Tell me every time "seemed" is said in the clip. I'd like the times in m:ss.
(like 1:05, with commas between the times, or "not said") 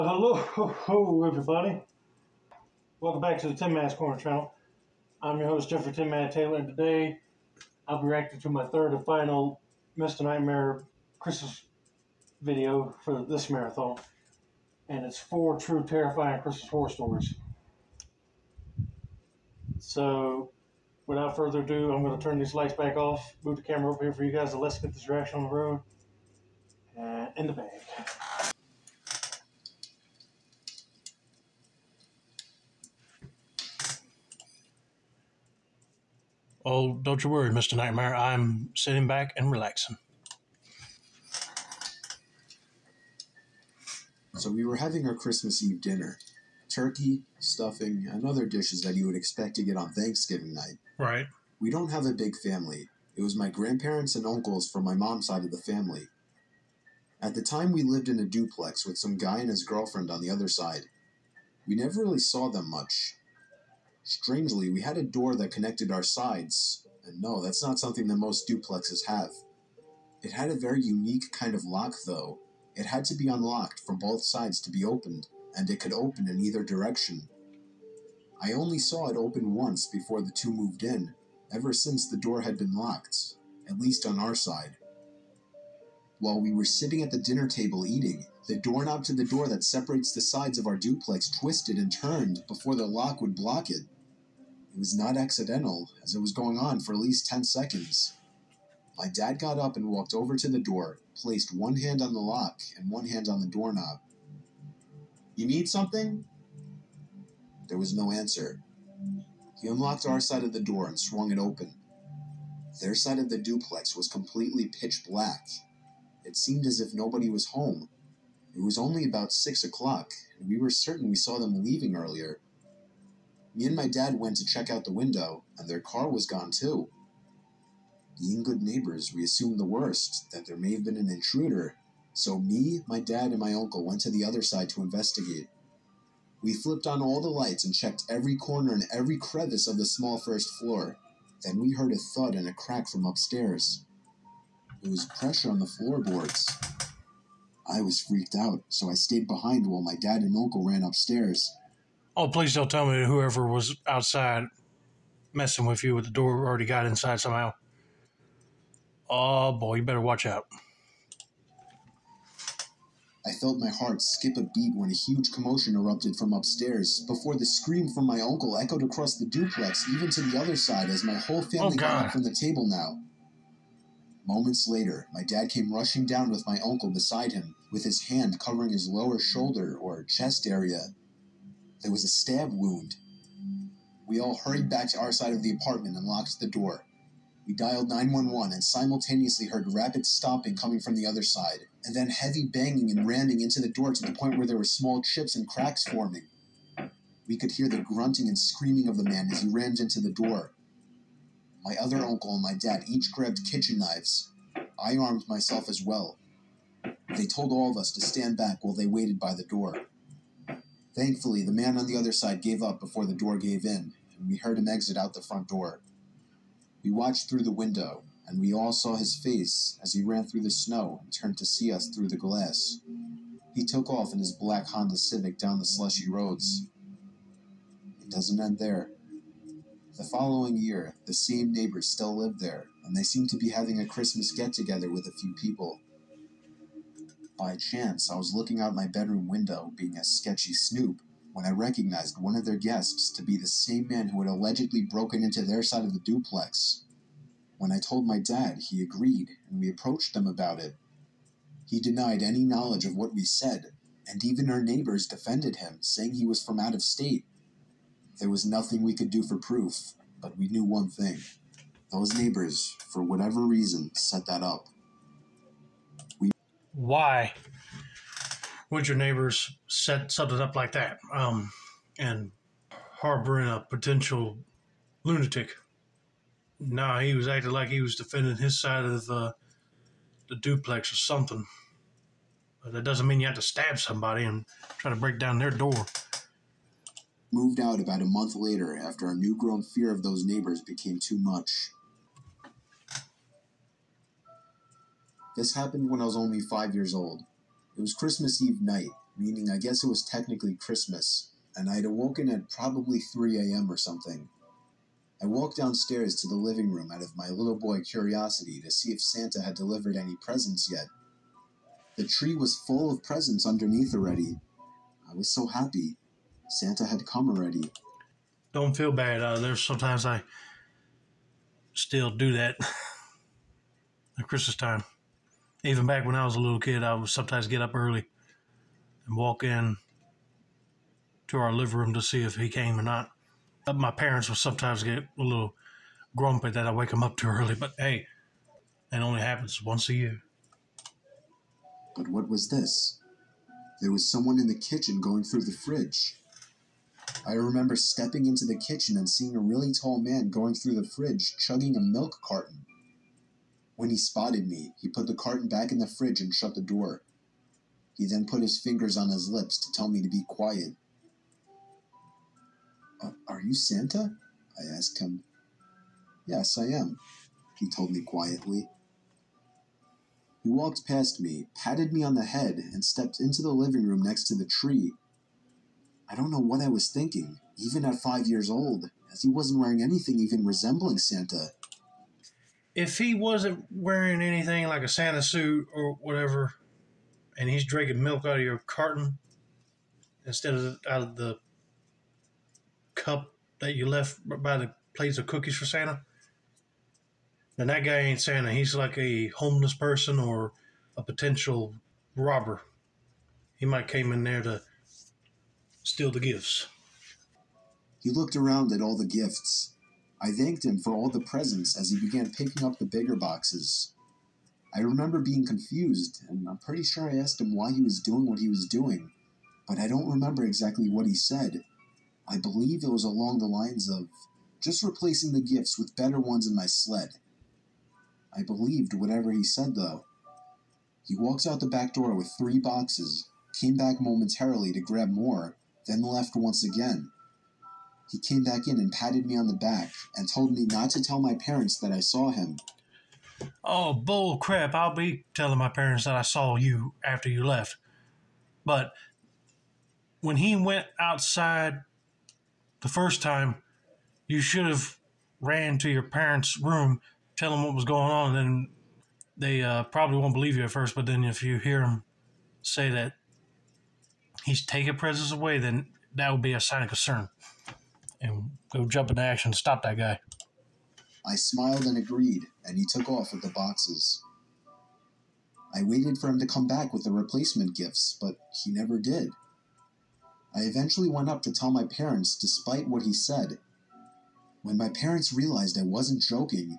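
1:56, 3:53.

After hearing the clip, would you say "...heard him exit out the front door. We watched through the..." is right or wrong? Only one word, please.
right.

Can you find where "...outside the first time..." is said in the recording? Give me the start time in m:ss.
7:30.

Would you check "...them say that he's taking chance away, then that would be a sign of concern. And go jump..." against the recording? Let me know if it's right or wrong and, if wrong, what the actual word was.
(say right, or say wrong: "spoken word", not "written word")
wrong: "presence", not "chance".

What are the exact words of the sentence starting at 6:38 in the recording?
He's like a homeless person or a potential robber.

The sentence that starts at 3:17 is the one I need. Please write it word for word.
We could hear the grunting and screaming of the man as he rammed into the door, my other mm-hmm.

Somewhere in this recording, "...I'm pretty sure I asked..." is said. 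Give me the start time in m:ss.
6:56.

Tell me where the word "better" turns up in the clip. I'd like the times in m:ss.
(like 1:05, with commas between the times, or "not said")
2:39, 7:05.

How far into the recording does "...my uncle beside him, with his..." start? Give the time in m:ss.
2:56.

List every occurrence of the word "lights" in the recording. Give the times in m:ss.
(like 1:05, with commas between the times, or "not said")
0:22, 2:17.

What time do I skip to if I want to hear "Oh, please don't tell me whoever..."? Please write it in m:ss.
2:32.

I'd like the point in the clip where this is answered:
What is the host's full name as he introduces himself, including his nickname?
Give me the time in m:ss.
0:05.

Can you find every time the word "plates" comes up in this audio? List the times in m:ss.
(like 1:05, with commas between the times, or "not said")
6:34.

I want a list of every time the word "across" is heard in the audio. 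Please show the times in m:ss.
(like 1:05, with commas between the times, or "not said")
2:48.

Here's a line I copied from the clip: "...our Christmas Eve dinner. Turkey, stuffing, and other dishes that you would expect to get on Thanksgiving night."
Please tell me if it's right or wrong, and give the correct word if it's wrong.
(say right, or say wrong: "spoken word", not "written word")
right.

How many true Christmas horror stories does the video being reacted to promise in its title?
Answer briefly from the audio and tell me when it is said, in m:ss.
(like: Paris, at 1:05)
4, at 0:15.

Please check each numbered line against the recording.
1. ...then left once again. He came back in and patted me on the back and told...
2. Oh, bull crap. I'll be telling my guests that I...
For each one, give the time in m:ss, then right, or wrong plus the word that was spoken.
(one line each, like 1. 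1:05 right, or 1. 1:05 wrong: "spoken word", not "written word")
1. 7:15 right
2. 7:23 wrong: "parents", not "guests".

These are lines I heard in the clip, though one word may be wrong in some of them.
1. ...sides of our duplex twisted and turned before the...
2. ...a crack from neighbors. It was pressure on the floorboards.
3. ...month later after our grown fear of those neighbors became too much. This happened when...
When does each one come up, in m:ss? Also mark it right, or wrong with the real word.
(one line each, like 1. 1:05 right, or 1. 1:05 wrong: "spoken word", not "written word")
1. 1:30 right
2. 2:22 wrong: "upstairs", not "neighbors"
3. 4:48 right.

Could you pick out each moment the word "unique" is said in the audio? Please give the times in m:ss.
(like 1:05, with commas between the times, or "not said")
1:10.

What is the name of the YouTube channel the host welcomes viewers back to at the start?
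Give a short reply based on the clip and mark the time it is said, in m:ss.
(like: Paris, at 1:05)
Tin Man's Corner, at 0:03.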